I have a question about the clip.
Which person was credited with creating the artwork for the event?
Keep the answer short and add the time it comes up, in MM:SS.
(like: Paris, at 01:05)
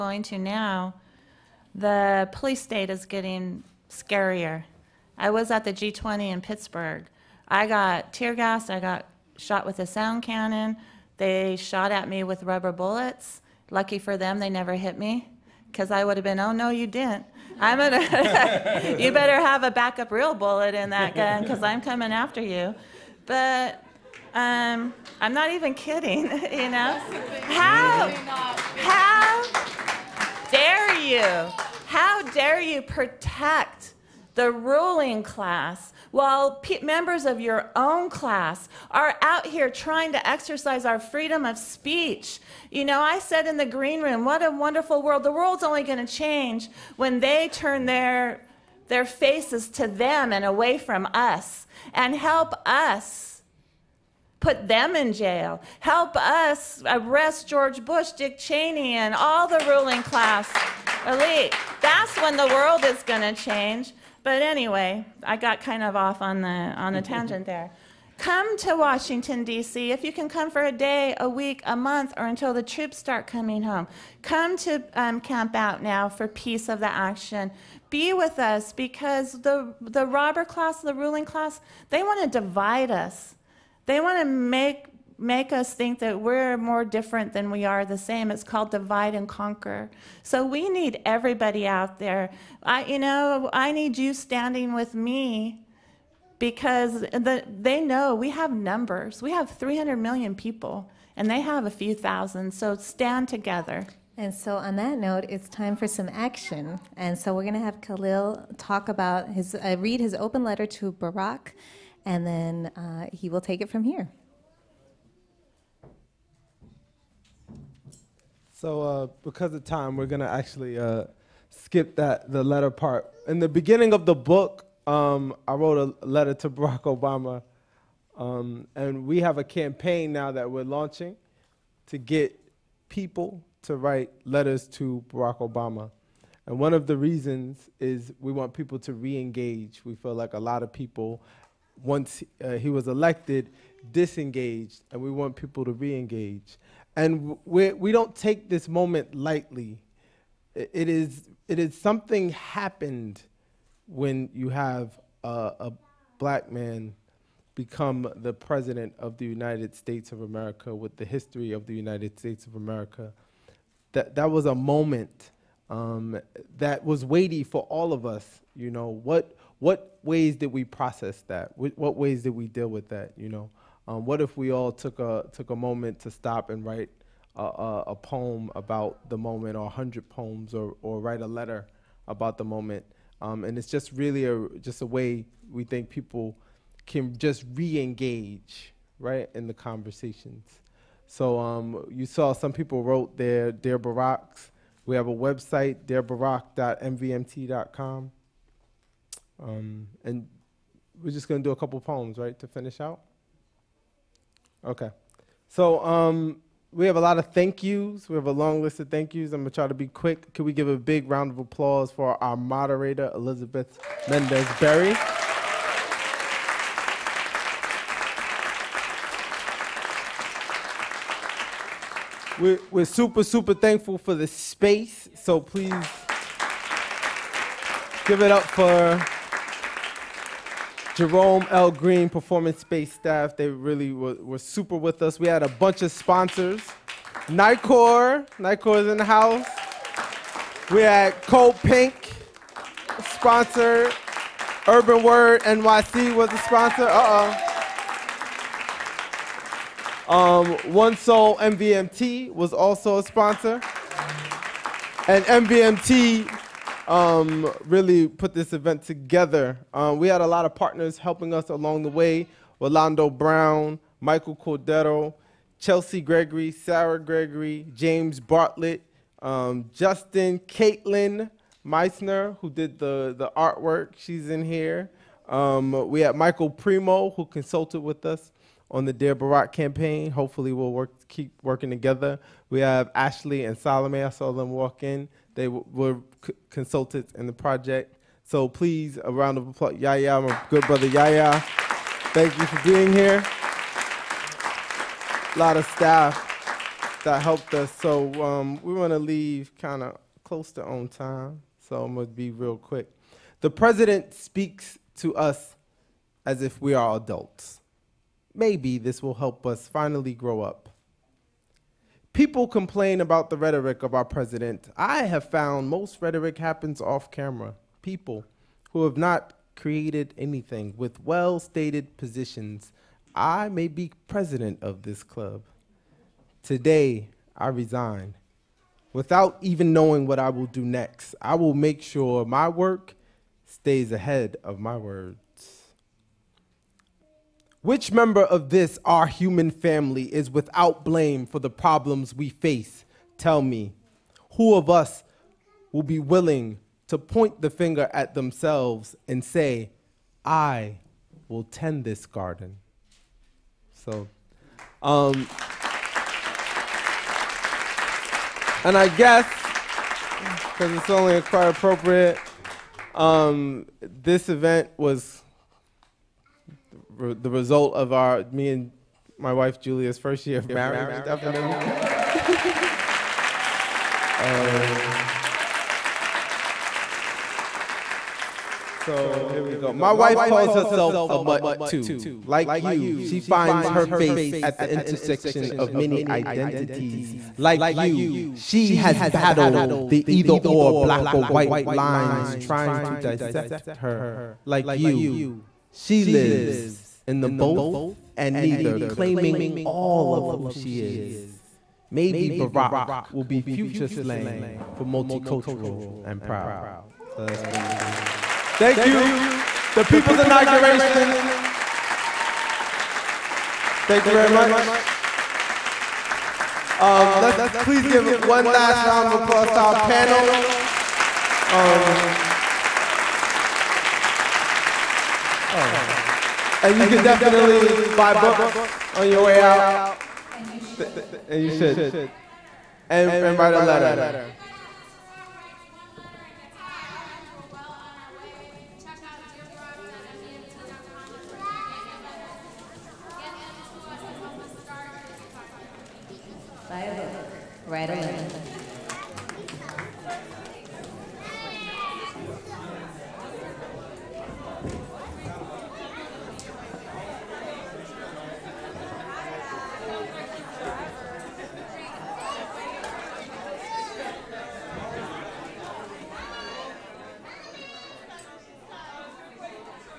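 Caitlin Meissner, at 04:30.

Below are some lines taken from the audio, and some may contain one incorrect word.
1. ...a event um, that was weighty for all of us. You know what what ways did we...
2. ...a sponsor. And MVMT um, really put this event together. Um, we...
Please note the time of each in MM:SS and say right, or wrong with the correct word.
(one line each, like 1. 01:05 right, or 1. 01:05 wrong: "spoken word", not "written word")
1. 02:44 wrong: "moment", not "event"
2. 04:12 right.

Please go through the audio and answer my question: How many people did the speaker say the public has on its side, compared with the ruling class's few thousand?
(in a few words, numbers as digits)
300 million.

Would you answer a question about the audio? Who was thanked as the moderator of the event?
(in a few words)
Elizabeth Mendez Berry.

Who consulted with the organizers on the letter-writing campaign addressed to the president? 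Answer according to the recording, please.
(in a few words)
Michael Primo.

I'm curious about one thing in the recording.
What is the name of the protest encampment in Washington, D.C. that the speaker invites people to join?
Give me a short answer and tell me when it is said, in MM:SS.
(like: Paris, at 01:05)
Camp Out Now for Peace of the Action, at 01:15.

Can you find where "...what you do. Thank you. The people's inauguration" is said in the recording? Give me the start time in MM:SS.
06:47.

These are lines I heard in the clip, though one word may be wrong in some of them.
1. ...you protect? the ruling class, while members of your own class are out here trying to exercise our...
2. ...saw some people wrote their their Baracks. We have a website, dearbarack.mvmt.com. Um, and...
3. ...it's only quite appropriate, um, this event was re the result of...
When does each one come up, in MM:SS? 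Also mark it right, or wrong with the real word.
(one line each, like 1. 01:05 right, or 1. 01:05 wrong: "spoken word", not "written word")
1. 00:32 right
2. 03:12 right
3. 06:00 right.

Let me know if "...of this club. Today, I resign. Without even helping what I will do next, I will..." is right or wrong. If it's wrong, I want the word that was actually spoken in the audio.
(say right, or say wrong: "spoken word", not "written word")
wrong: "knowing", not "helping".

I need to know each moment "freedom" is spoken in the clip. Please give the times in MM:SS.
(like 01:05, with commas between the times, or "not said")
00:40.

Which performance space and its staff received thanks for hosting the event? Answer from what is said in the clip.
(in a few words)
Jerome L. Greene.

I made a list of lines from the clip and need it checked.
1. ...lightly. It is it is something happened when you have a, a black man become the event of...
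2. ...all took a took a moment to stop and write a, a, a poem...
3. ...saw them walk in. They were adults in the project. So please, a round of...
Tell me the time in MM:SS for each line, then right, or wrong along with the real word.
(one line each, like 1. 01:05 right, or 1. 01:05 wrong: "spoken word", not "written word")
1. 02:29 wrong: "president", not "event"
2. 02:54 right
3. 04:44 wrong: "consultants", not "adults".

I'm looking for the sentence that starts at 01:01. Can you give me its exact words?
That's when the world is going to change.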